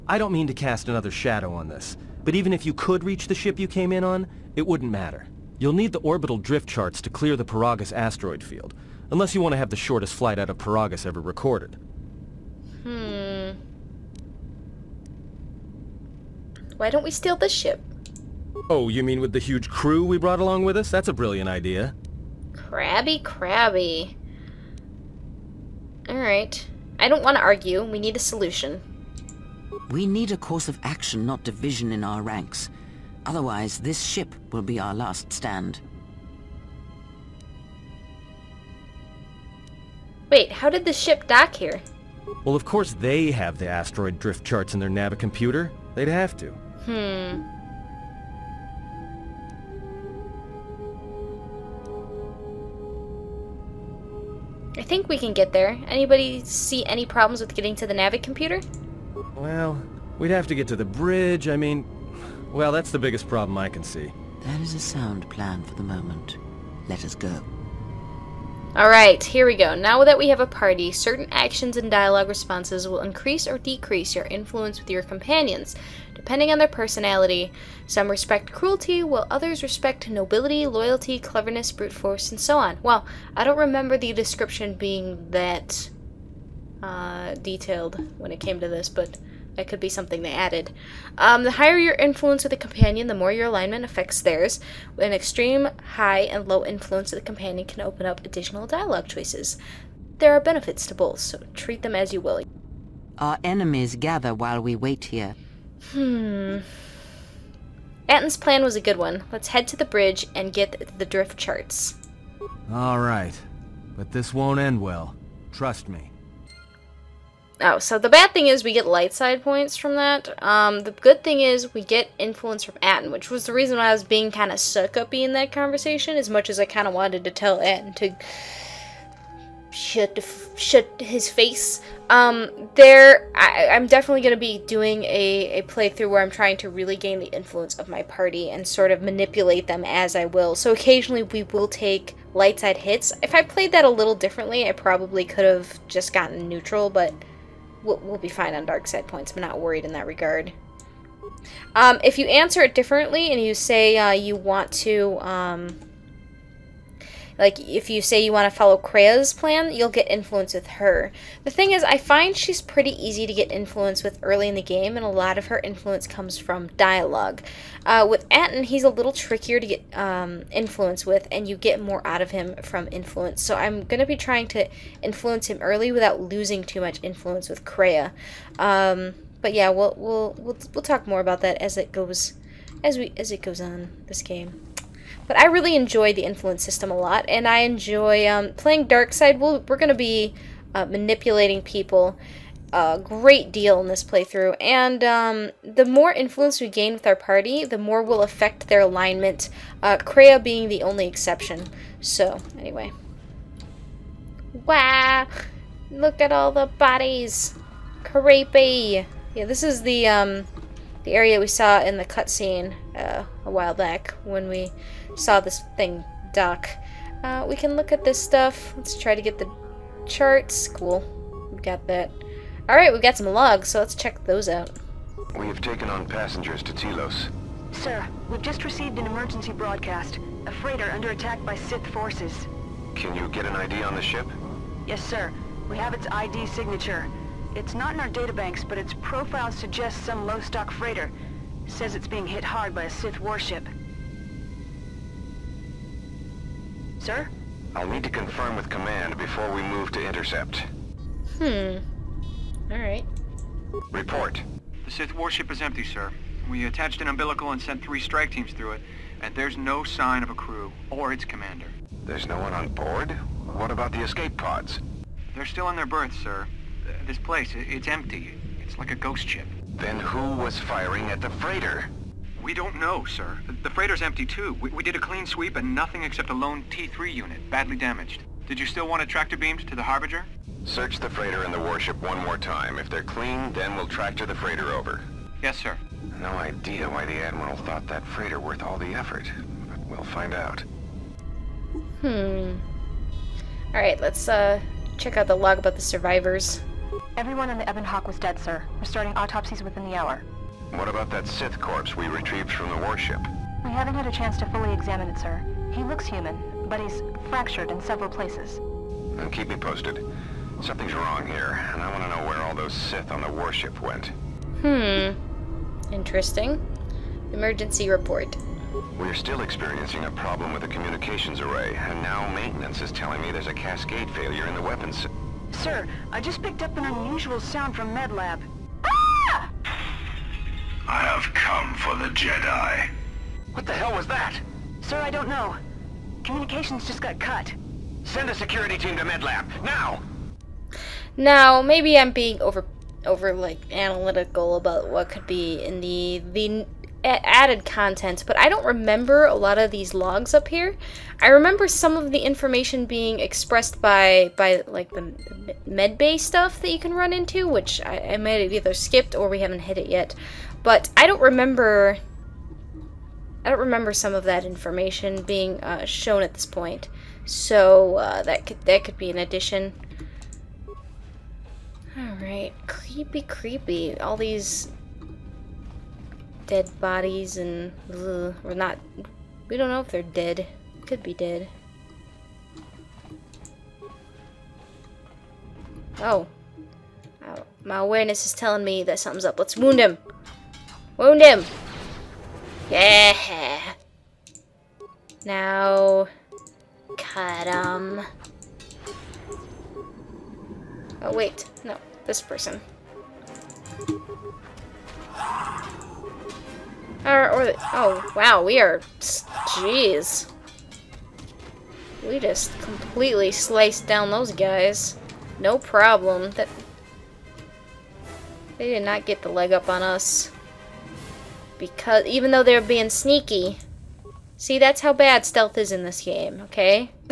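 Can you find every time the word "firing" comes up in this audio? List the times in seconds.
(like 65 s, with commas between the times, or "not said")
270 s.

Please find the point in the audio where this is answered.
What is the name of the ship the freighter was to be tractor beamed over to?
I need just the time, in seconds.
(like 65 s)
279 s.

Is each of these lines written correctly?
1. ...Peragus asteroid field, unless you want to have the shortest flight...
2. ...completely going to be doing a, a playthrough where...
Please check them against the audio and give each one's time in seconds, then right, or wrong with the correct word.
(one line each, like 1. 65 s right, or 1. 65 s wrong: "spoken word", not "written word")
1. 7 s right
2. 133 s wrong: "definitely", not "completely".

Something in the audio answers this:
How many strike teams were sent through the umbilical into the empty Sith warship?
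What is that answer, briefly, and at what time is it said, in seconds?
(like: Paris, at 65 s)
3, at 257 s.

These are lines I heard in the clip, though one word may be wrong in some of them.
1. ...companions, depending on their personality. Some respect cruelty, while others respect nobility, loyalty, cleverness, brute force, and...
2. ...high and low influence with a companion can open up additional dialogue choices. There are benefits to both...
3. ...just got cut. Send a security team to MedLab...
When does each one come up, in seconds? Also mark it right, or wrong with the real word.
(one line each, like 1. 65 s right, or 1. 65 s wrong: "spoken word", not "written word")
1. 75 s right
2. 95 s right
3. 336 s right.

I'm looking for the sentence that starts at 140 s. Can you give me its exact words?
So occasionally we will take light side hits.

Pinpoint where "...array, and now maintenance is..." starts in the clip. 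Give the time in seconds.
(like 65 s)
321 s.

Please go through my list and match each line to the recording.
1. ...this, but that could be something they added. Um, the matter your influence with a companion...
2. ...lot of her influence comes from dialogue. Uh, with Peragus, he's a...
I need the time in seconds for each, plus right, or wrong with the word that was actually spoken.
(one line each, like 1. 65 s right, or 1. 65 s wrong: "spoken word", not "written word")
1. 88 s wrong: "higher", not "matter"
2. 165 s wrong: "Atton", not "Peragus".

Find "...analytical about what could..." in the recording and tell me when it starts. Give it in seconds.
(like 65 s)
343 s.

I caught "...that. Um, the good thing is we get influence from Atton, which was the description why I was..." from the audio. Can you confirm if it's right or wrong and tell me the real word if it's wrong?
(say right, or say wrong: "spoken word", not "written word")
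wrong: "reason", not "description".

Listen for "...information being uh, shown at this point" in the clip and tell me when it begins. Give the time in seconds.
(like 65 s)
364 s.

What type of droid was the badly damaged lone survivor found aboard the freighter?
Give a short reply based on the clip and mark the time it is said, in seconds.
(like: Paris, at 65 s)
T-3 unit, at 276 s.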